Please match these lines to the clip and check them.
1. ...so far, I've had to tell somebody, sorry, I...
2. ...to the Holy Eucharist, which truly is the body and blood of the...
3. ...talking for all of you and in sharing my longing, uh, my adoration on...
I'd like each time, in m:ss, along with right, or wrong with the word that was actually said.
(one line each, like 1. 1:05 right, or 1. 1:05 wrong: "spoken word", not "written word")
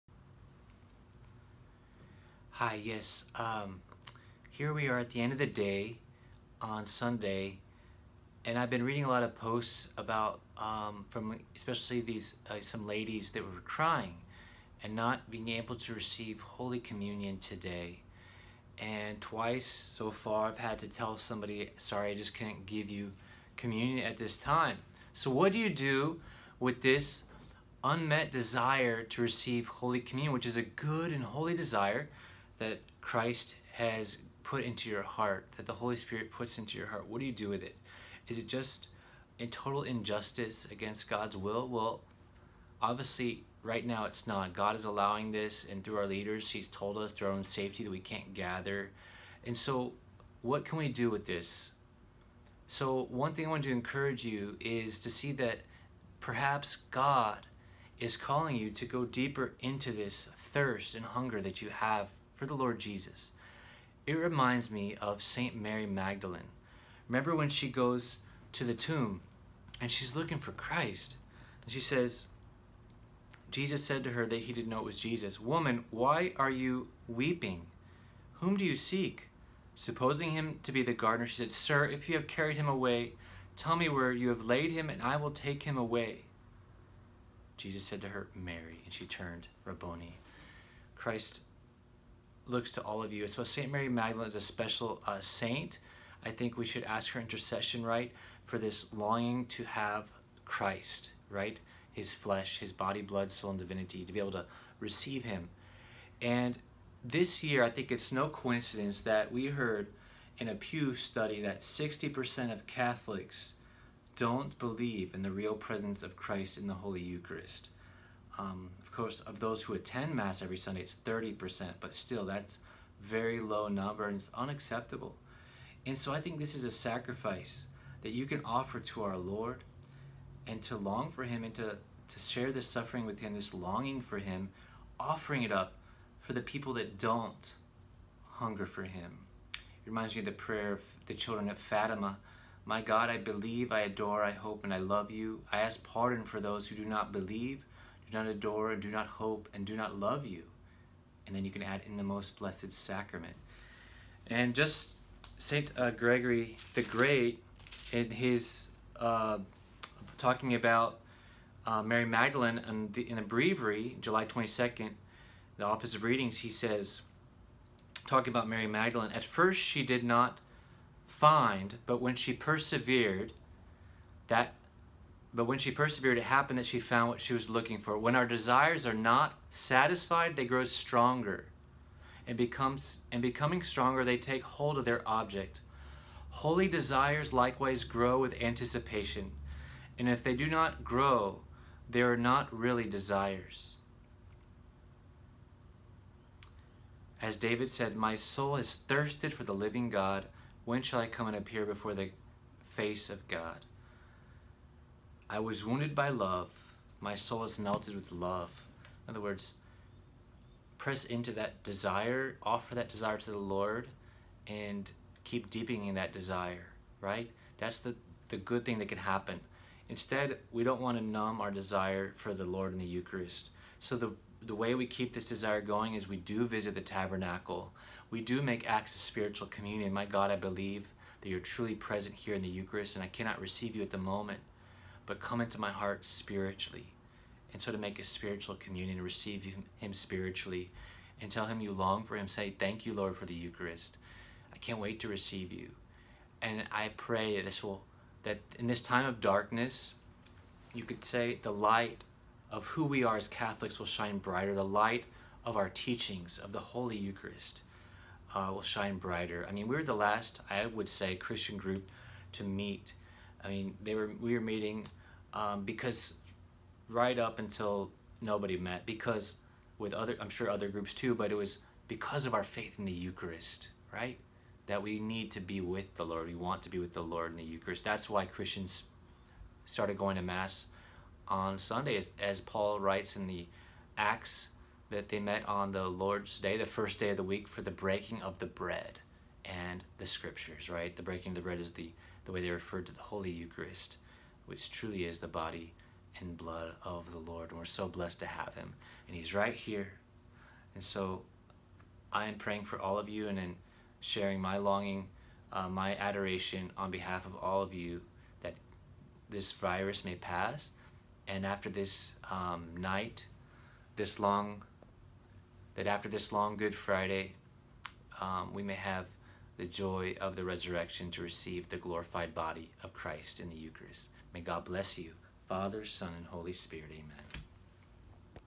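1. 0:19 right
2. 4:52 right
3. 5:02 wrong: "praying", not "talking".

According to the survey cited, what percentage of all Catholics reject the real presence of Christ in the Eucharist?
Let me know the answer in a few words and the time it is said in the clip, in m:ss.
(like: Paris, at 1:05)
60%, at 1:51.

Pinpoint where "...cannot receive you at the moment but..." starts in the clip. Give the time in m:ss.
3:53.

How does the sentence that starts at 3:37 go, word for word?
That's the, the good thing that can happen.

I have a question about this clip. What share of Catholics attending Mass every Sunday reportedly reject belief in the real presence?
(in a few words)
30%.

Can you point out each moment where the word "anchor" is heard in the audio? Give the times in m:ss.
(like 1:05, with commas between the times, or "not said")
not said.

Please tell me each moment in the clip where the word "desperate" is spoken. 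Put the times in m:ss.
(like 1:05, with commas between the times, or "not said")
not said.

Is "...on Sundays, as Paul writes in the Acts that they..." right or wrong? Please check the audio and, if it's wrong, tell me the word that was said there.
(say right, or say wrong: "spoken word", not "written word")
right.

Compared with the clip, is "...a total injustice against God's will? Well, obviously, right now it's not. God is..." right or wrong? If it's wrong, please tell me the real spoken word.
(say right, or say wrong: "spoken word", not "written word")
right.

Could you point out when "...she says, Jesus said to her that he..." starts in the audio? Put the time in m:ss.
1:11.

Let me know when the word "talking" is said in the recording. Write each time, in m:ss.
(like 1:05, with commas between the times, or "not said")
2:40, 2:48.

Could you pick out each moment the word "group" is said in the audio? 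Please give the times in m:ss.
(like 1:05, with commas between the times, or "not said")
4:21, 4:30.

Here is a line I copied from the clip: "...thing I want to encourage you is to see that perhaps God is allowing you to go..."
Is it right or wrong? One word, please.
wrong.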